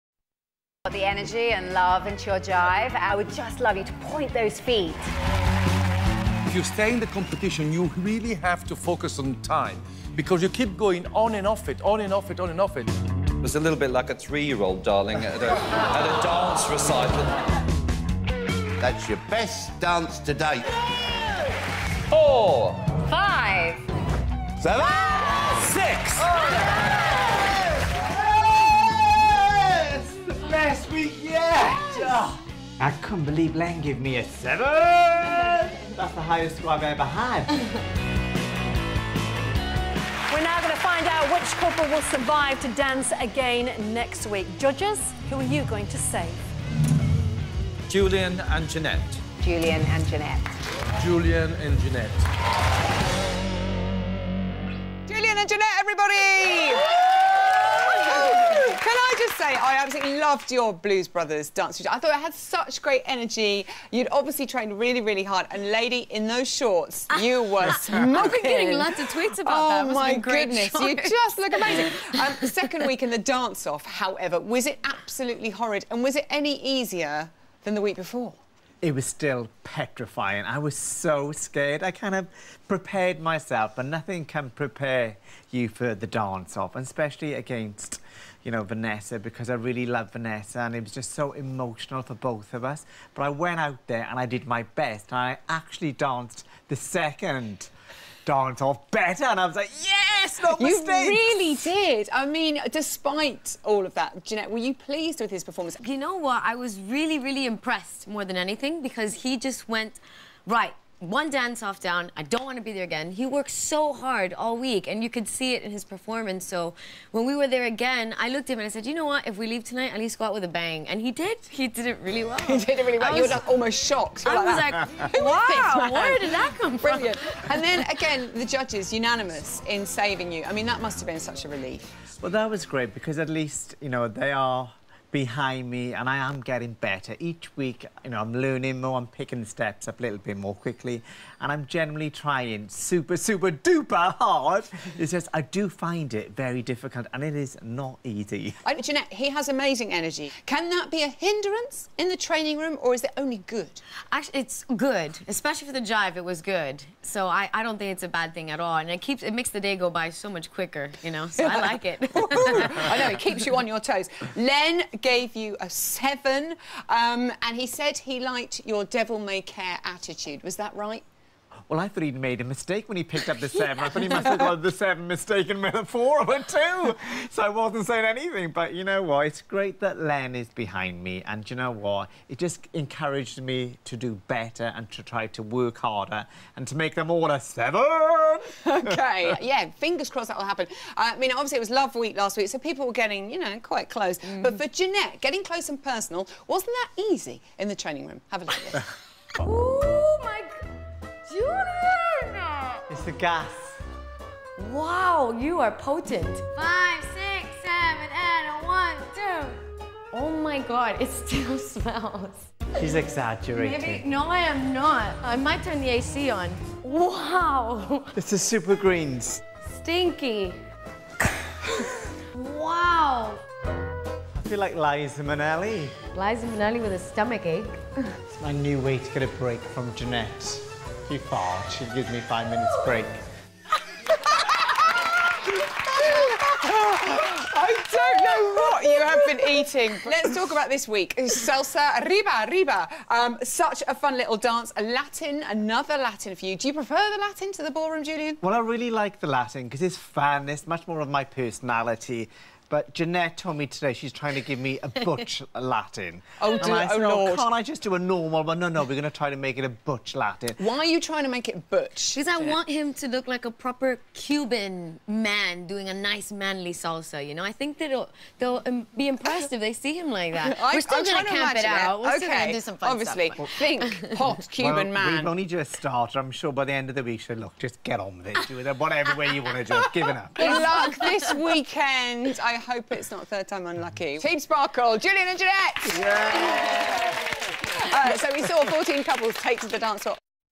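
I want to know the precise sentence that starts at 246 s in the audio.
Do you prefer the Latin to the ballroom, Julien?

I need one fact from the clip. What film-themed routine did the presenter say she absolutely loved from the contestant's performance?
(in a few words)
Blues Brothers.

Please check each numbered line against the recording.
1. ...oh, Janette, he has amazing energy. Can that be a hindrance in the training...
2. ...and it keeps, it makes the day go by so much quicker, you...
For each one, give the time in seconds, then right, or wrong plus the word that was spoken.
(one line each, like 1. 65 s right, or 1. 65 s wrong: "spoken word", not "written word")
1. 148 s right
2. 158 s right.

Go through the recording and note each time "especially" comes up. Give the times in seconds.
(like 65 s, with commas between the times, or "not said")
86 s, 155 s.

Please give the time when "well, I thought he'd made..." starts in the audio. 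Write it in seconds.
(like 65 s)
171 s.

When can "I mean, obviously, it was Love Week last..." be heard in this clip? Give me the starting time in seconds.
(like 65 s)
190 s.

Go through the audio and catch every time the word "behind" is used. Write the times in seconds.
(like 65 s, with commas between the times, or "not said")
135 s, 180 s.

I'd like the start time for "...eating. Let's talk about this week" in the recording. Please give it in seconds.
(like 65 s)
239 s.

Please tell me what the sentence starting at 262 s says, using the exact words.
Because I want him to look like a proper Cuban man doing a nice manly salsa, you know?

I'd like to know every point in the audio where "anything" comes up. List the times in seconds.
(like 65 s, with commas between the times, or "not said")
108 s, 178 s.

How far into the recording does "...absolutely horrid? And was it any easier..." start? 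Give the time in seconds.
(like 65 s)
74 s.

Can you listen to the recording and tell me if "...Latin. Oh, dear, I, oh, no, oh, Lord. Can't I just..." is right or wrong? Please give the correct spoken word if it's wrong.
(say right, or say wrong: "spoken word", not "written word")
right.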